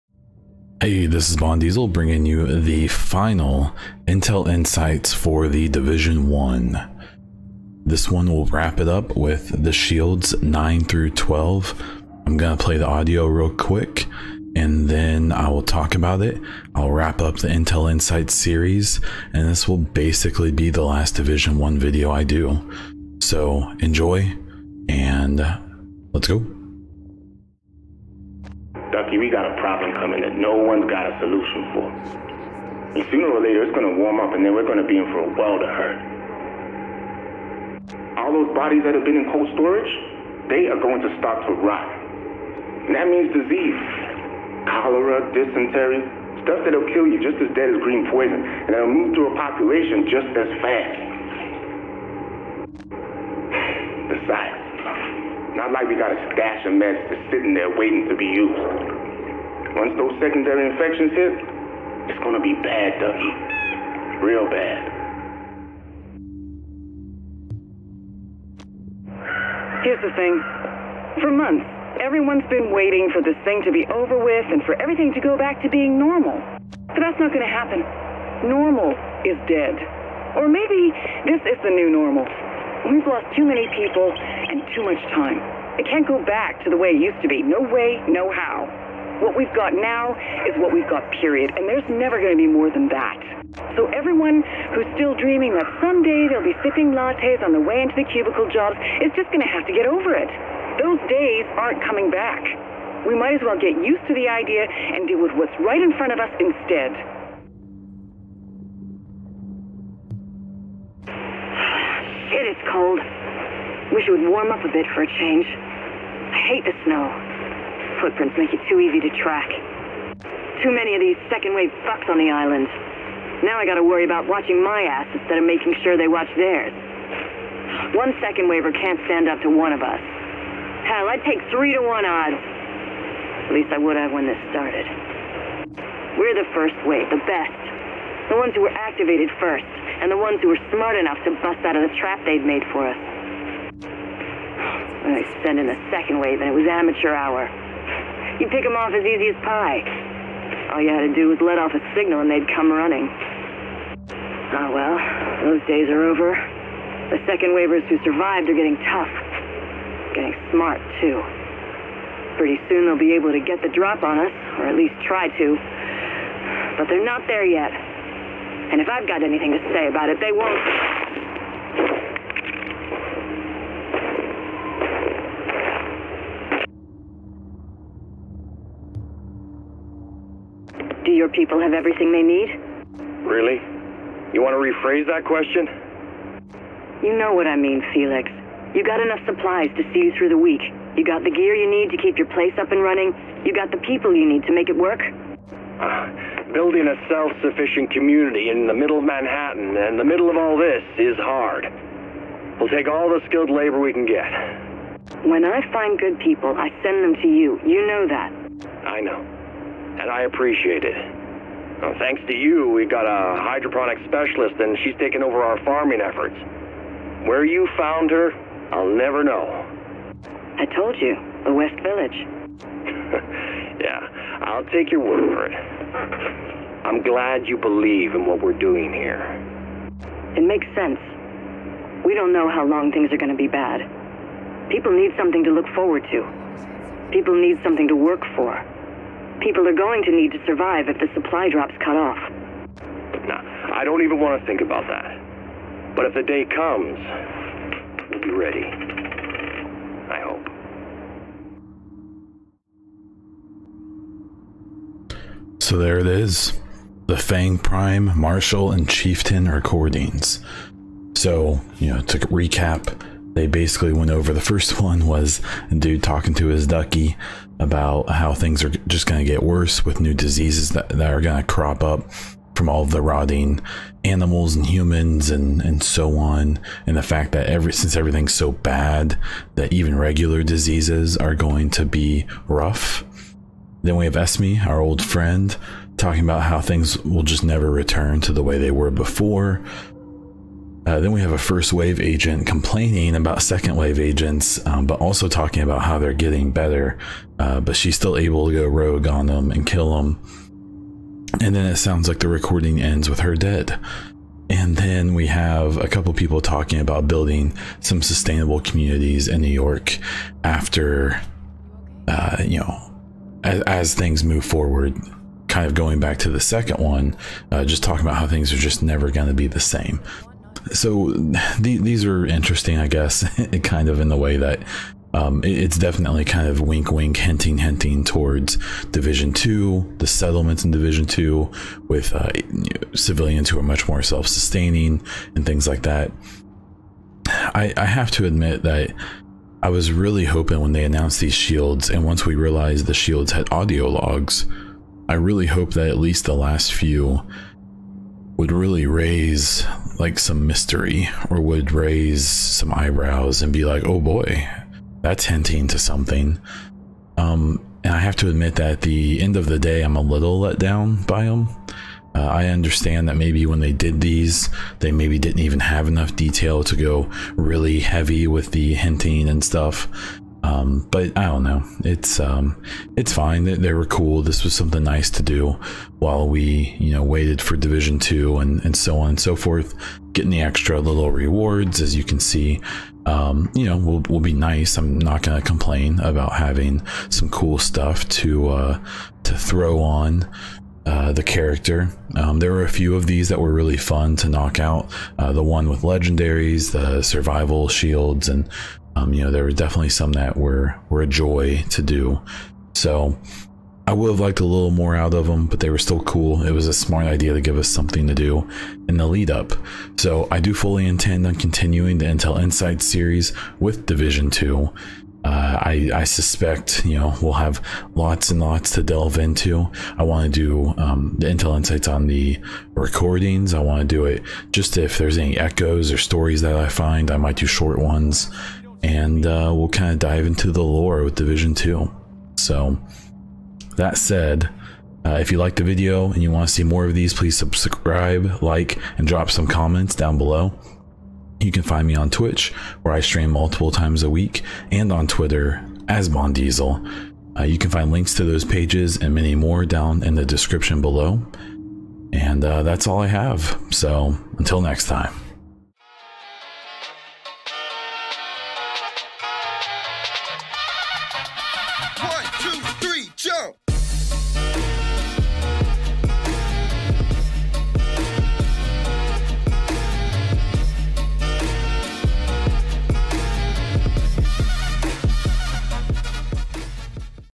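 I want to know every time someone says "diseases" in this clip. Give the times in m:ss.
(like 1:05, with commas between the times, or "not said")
0:43, 4:30, 4:40.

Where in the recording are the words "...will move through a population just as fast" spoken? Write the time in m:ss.
0:48.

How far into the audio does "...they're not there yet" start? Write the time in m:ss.
2:46.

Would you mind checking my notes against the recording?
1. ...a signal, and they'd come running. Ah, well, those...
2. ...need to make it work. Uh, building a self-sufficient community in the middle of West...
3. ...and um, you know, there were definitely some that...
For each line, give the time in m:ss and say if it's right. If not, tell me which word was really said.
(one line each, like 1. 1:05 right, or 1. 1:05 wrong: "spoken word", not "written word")
1. 2:31 right
2. 3:14 wrong: "Manhattan", not "West"
3. 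6:38 right.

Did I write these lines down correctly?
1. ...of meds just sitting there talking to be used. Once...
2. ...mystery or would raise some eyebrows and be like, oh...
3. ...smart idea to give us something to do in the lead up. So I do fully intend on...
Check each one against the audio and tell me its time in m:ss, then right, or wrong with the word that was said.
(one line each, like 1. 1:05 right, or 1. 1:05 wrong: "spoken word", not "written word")
1. 0:56 wrong: "waiting", not "talking"
2. 5:50 right
3. 6:46 right.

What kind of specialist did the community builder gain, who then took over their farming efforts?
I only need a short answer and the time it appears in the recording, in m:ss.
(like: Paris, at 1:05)
Hydroponic specialist, at 3:33.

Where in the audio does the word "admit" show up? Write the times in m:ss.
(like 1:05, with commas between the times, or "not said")
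5:38, 5:58.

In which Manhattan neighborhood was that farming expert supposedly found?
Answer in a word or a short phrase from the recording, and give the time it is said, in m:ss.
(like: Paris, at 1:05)
West Village, at 3:41.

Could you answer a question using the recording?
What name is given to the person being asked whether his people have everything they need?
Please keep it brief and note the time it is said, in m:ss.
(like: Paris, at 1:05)
Felix, at 3:07.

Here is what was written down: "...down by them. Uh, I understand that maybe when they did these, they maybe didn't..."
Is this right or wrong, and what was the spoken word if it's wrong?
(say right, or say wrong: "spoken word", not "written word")
right.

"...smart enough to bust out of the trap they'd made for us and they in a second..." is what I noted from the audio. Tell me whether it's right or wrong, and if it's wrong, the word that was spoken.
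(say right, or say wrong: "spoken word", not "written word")
right.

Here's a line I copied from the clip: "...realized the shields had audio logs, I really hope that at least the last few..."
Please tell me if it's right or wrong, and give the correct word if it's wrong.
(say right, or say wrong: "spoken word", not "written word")
right.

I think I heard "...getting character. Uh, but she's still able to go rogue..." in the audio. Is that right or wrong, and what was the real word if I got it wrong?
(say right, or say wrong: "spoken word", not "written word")
wrong: "better", not "character".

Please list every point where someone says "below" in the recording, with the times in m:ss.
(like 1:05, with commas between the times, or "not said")
7:20, 7:30.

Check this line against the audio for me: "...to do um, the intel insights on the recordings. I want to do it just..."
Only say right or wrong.
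right.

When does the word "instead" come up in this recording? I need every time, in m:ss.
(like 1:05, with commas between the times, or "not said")
1:46, 2:05.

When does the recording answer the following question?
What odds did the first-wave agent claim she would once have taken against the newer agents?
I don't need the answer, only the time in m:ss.
2:11.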